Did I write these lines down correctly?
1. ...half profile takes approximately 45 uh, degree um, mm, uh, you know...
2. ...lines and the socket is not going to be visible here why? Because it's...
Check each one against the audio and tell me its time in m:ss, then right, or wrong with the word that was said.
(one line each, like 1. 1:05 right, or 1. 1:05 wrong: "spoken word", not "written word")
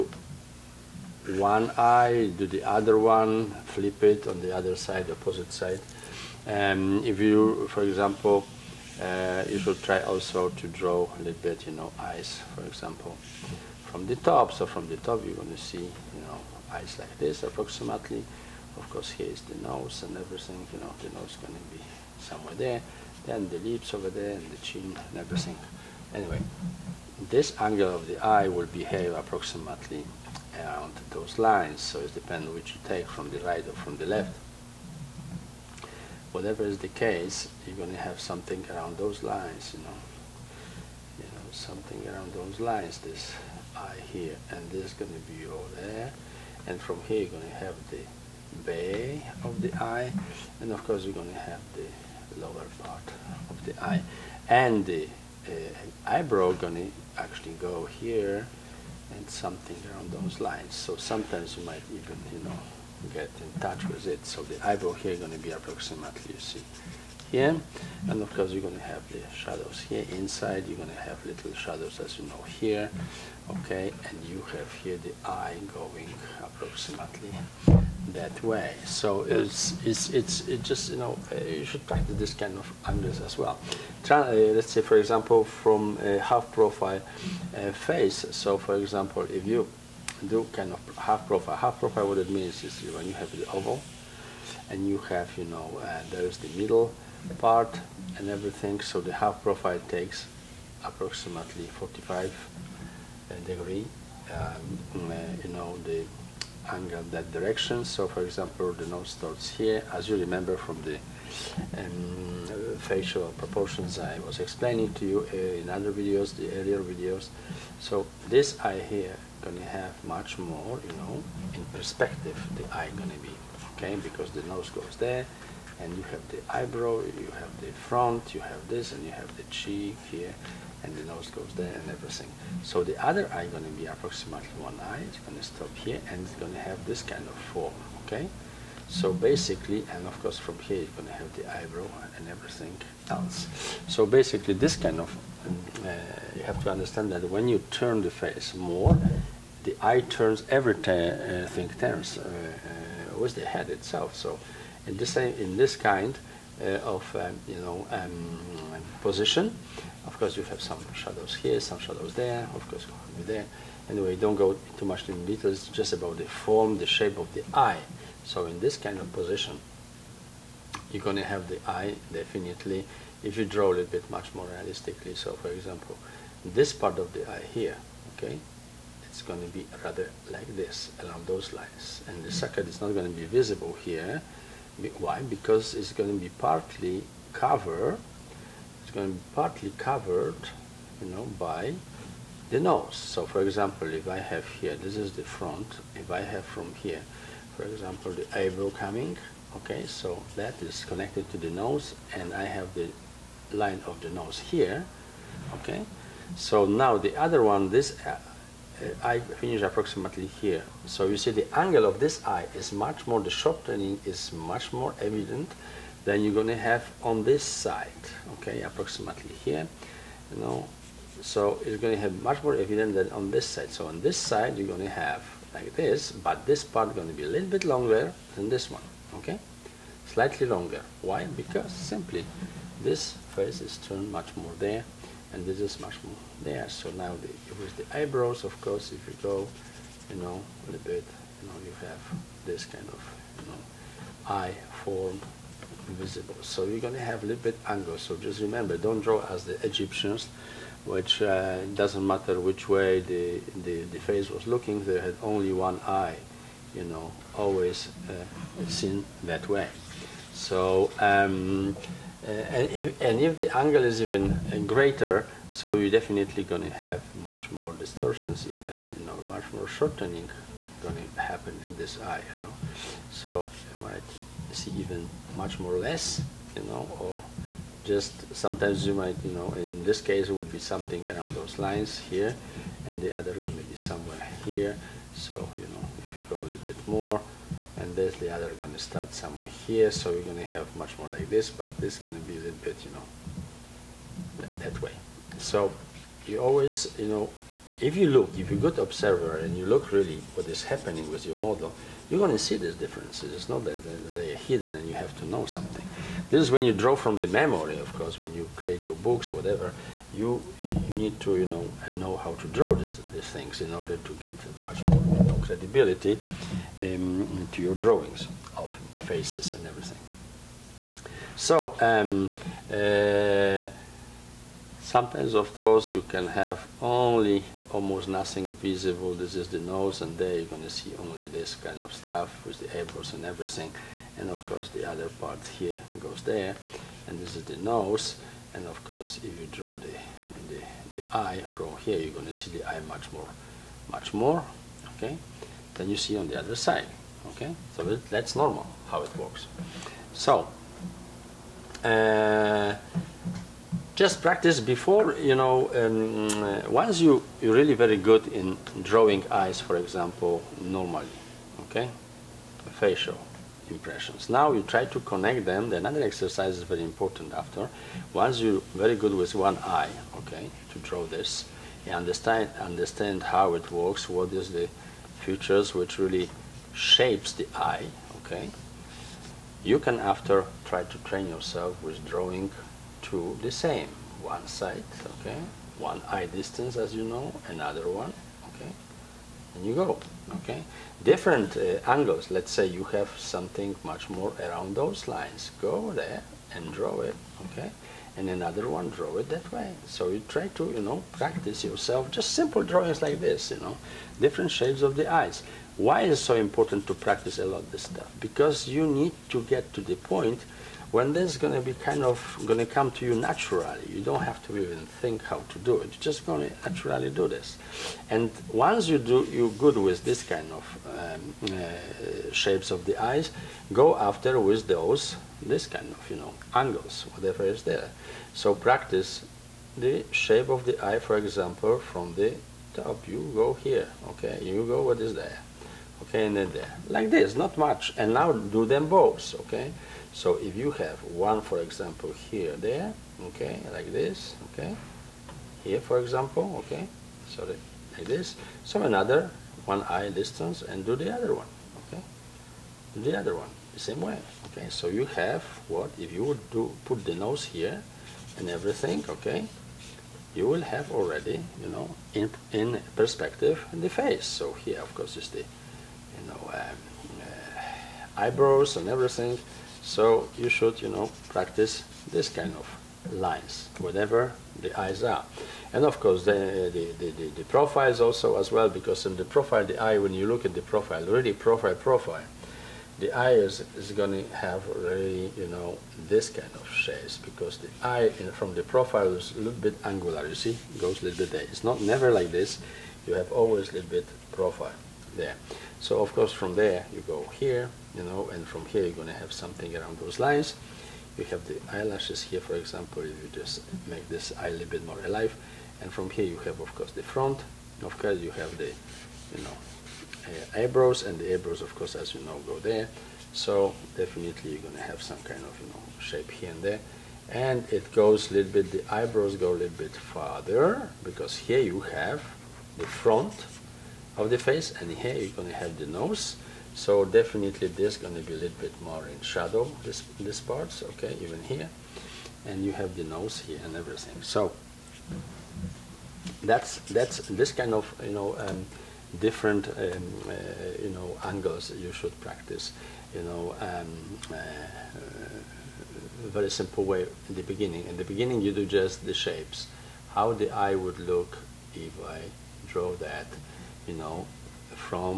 1. 1:39 right
2. 3:01 right.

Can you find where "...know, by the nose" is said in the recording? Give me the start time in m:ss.
3:11.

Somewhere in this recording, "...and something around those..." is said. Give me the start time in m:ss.
0:59.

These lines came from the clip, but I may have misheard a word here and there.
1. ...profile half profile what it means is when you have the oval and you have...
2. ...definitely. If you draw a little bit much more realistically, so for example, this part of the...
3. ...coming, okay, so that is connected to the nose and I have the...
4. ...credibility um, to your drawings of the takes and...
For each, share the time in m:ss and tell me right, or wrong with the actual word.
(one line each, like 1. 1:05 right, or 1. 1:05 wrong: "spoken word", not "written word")
1. 1:31 right
2. 2:52 right
3. 3:18 right
4. 5:15 wrong: "faces", not "takes".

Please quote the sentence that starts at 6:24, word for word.
One side, okay, one eye distance as you know, another one, okay and you go.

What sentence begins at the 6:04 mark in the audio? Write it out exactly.
Now you try to connect them.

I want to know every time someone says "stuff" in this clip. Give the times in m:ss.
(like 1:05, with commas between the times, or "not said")
5:31, 6:47.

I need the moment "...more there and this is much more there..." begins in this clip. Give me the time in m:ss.
3:54.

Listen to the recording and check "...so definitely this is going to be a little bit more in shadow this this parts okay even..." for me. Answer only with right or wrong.
right.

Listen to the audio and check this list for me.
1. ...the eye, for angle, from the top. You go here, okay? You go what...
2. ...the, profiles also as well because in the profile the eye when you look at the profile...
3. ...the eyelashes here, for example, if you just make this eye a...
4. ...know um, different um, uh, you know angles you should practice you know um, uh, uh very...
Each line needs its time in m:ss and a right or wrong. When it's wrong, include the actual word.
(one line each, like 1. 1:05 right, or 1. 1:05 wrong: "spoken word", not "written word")
1. 7:10 wrong: "example", not "angle"
2. 7:57 right
3. 8:21 right
4. 8:58 right.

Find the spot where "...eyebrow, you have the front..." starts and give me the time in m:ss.
2:06.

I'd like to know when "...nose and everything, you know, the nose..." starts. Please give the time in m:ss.
0:19.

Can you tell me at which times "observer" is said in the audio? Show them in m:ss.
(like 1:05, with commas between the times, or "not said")
4:58.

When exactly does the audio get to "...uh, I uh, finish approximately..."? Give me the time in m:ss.
3:28.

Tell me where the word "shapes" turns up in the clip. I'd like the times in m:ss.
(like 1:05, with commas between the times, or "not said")
2:46, 6:16, 6:44, 7:02, 7:10, 8:06, 8:35, 9:09.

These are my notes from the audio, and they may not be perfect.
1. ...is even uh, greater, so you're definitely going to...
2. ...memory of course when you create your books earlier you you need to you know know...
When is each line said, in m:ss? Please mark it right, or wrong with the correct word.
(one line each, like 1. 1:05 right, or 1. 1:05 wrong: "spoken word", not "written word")
1. 4:23 right
2. 5:07 wrong: "whatever", not "earlier".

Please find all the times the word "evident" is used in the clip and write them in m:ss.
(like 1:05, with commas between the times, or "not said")
3:34, 3:42.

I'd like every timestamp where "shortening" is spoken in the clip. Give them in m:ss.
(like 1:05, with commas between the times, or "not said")
3:33, 4:29.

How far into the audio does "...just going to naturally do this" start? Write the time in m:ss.
6:56.